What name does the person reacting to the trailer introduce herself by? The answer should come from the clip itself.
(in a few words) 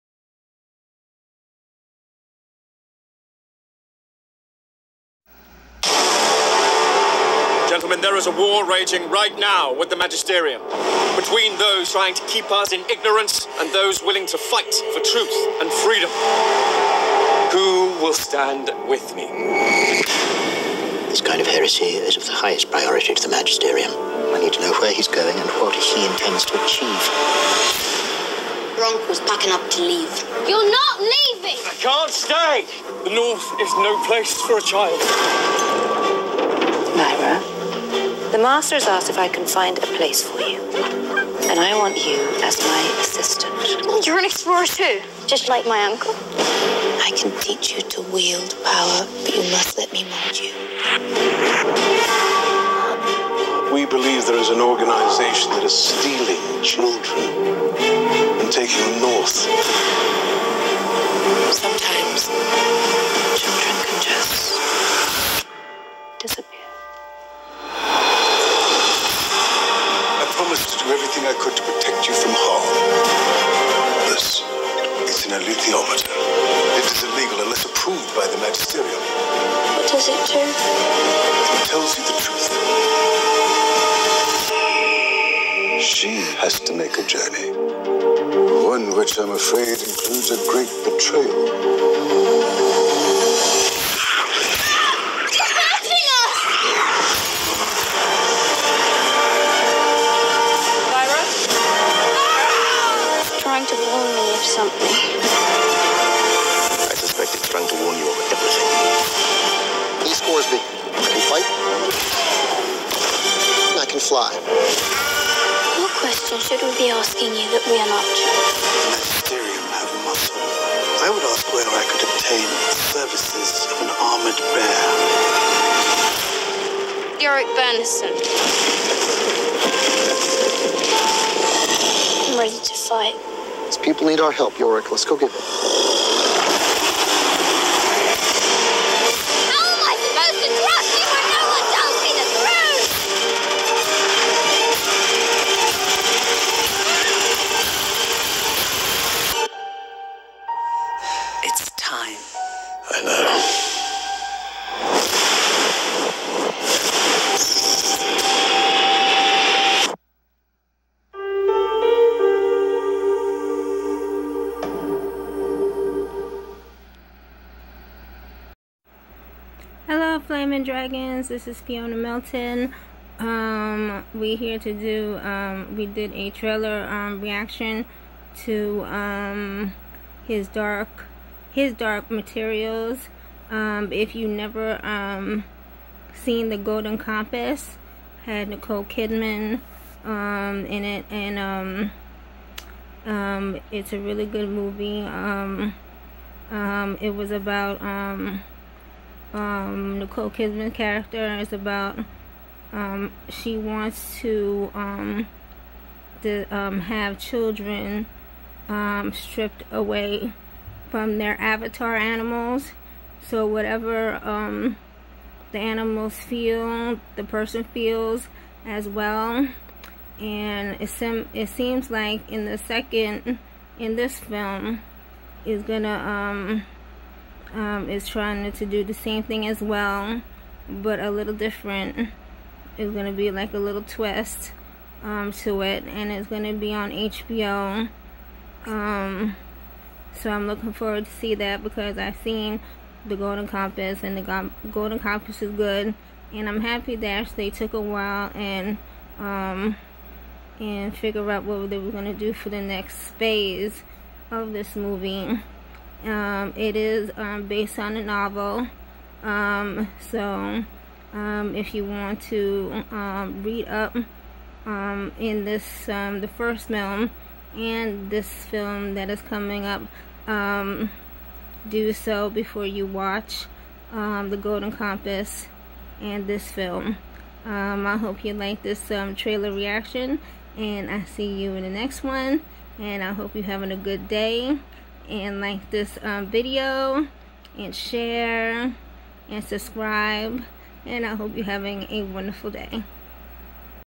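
Fiona Melton.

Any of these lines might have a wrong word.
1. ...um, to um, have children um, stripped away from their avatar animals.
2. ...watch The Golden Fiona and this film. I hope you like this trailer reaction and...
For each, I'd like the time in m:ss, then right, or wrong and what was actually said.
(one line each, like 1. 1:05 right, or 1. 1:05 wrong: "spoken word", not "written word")
1. 3:24 right
2. 4:32 wrong: "Compass", not "Fiona".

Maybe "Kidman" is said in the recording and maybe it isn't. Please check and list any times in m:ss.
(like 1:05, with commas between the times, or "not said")
3:08, 3:20.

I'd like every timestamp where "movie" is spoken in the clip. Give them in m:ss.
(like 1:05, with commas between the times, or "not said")
3:14, 4:14.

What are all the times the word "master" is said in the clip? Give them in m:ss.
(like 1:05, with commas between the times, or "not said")
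0:38.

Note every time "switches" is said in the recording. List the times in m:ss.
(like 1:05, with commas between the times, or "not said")
not said.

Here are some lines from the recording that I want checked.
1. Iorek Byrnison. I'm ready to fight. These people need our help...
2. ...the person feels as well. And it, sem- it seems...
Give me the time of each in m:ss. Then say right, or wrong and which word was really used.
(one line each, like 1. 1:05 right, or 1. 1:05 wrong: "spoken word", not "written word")
1. 2:07 right
2. 3:37 right.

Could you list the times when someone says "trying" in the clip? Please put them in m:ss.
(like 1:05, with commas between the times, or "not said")
0:11, 3:48.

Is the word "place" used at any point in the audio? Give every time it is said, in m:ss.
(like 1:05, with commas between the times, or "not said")
0:34, 0:39.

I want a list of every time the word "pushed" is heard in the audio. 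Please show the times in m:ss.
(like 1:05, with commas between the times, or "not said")
not said.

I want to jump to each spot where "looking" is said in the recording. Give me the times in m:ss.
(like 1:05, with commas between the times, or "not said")
4:00.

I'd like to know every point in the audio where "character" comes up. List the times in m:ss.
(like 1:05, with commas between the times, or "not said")
3:20.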